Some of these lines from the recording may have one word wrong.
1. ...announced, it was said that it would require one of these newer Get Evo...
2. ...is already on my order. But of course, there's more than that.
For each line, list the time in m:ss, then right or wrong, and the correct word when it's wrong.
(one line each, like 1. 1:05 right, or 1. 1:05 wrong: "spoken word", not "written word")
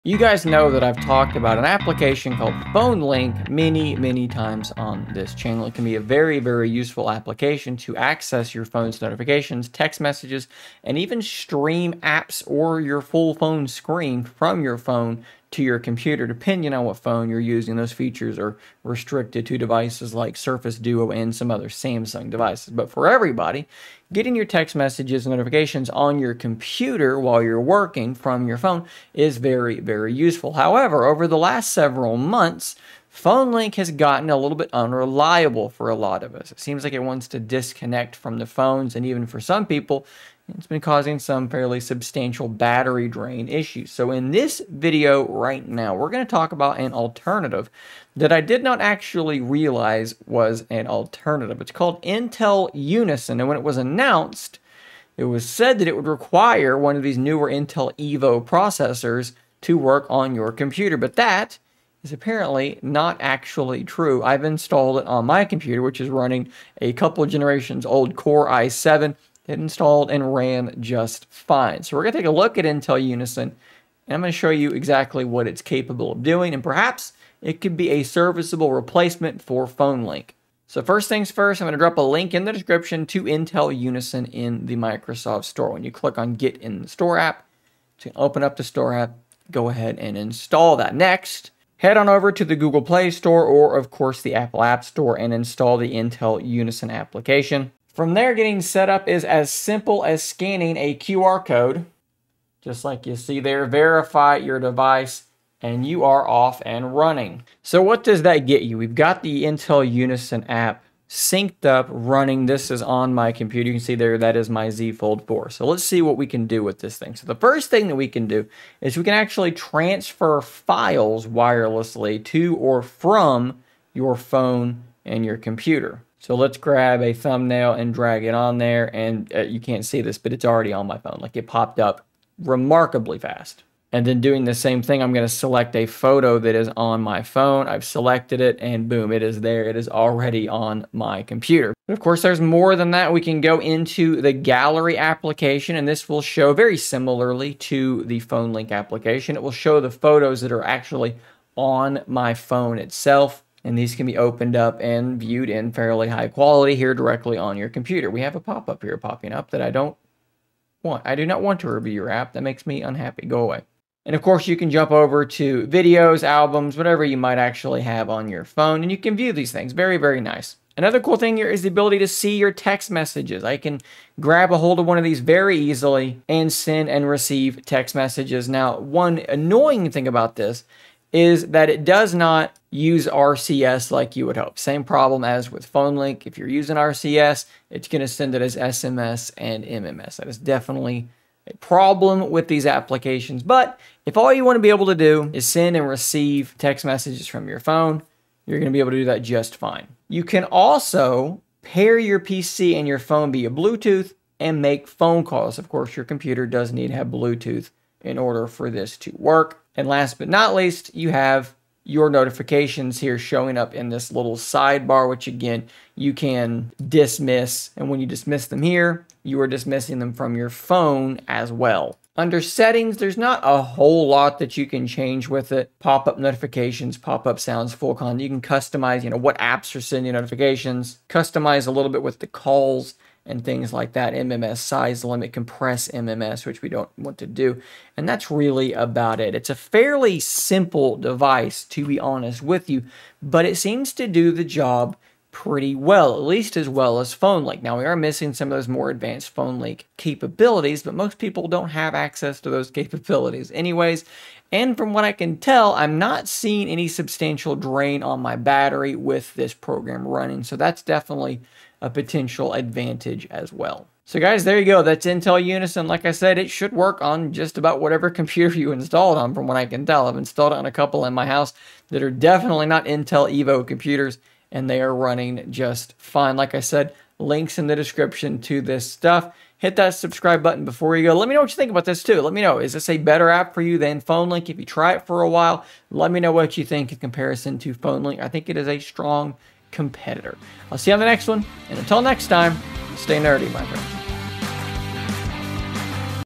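1. 0:53 wrong: "Intel", not "Get"
2. 2:19 wrong: "computer", not "order".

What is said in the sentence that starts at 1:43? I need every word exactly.
Verify your device and you are off and running.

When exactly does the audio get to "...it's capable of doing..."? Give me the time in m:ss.
1:15.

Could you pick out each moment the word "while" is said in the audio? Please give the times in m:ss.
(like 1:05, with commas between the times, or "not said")
0:27, 4:45.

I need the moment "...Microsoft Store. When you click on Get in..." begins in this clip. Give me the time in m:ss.
1:24.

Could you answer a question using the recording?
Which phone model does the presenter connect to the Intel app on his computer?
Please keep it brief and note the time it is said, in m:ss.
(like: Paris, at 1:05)
Z Fold 4, at 1:54.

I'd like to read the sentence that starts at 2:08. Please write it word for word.
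And uh, you can't see this, but it's already on my phone.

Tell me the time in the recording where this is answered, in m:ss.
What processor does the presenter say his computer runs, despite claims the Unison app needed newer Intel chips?
1:08.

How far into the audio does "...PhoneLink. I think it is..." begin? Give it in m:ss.
4:47.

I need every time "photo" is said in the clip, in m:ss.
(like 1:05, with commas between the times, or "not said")
2:15, 2:29.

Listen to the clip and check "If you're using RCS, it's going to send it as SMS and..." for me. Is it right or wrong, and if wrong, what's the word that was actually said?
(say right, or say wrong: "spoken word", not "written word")
right.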